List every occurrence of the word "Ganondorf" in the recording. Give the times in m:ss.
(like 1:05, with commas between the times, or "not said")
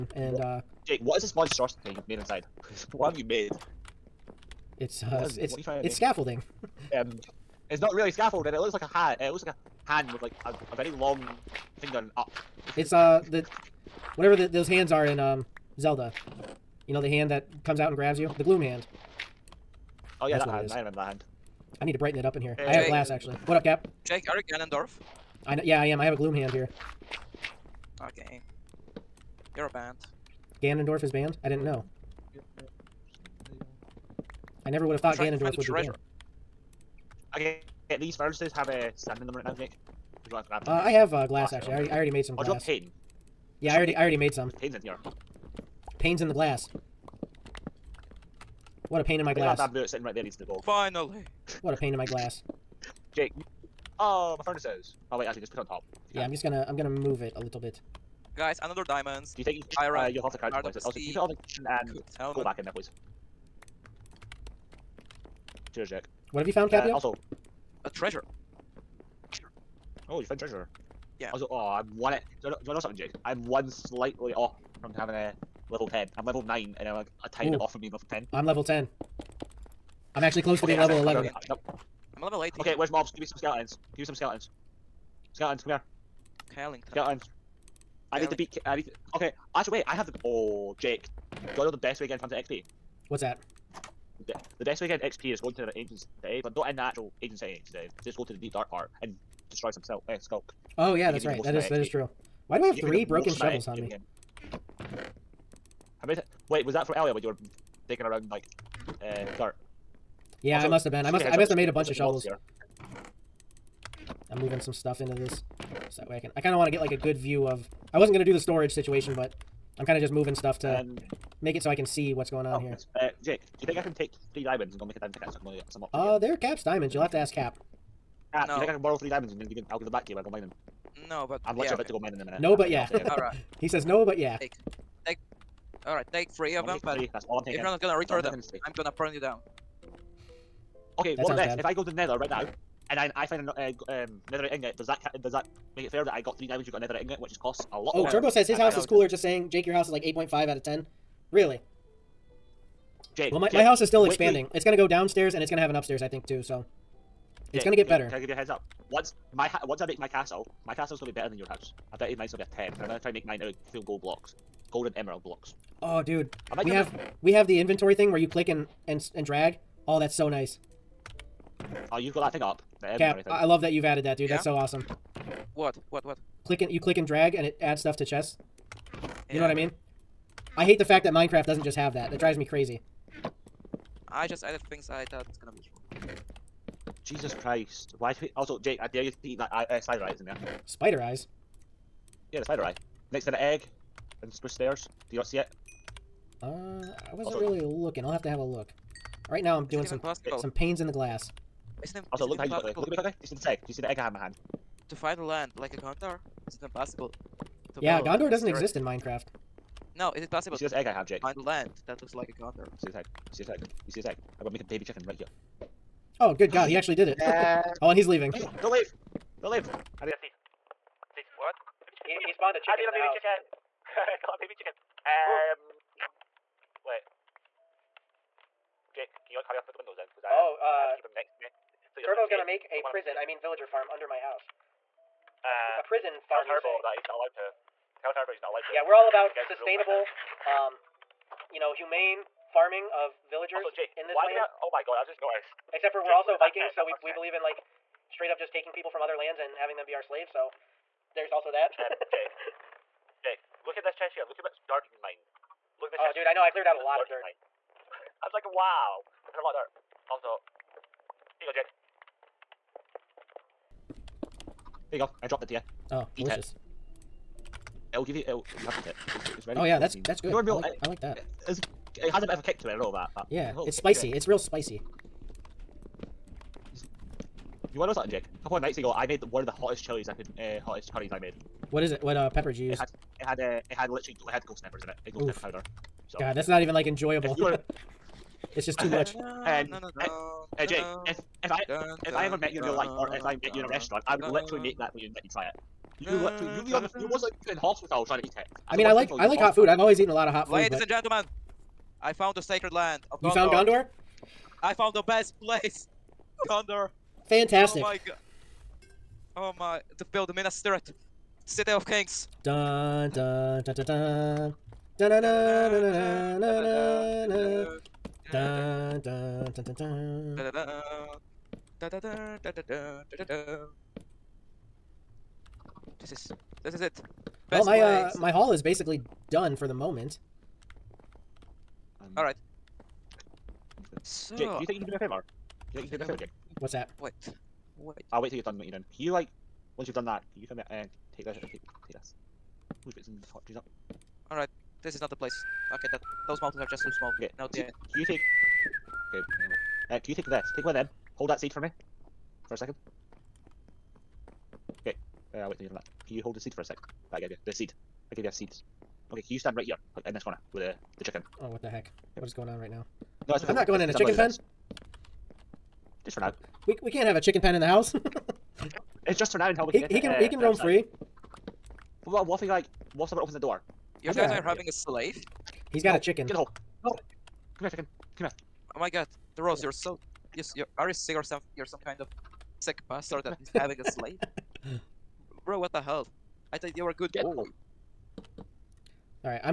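0:24, 0:30, 0:35.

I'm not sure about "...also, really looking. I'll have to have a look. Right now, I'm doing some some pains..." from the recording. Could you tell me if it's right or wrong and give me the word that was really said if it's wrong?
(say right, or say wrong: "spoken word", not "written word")
right.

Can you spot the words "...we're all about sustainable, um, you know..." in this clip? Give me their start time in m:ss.
3:58.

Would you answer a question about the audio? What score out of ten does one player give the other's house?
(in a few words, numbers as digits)
8.5.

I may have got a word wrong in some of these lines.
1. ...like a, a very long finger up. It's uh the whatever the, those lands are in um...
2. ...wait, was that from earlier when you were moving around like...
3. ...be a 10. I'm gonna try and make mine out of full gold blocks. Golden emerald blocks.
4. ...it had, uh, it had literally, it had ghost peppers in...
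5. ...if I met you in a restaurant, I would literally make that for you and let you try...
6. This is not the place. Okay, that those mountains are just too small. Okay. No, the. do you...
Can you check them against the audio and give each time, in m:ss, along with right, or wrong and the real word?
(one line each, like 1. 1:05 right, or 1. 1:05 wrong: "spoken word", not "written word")
1. 0:10 wrong: "hands", not "lands"
2. 1:46 wrong: "digging", not "moving"
3. 2:42 right
4. 4:43 right
5. 4:53 right
6. 5:44 right.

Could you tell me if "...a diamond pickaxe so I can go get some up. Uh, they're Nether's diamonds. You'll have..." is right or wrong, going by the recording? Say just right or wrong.
wrong.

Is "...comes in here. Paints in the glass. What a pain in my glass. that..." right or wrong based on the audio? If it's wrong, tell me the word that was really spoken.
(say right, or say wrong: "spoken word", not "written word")
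wrong: "panes", not "comes".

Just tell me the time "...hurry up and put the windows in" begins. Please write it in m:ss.
3:49.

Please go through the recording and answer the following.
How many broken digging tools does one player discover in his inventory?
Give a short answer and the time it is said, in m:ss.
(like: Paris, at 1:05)
3, at 1:42.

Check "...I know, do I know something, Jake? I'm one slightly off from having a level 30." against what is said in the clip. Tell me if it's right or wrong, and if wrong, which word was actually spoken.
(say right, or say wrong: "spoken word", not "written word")
wrong: "10", not "30".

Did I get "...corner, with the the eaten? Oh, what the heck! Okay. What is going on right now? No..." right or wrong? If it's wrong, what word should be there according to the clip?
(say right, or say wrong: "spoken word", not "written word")
wrong: "chicken", not "eaten".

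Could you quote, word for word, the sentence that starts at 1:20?
I'm actually close to okay, being level 11.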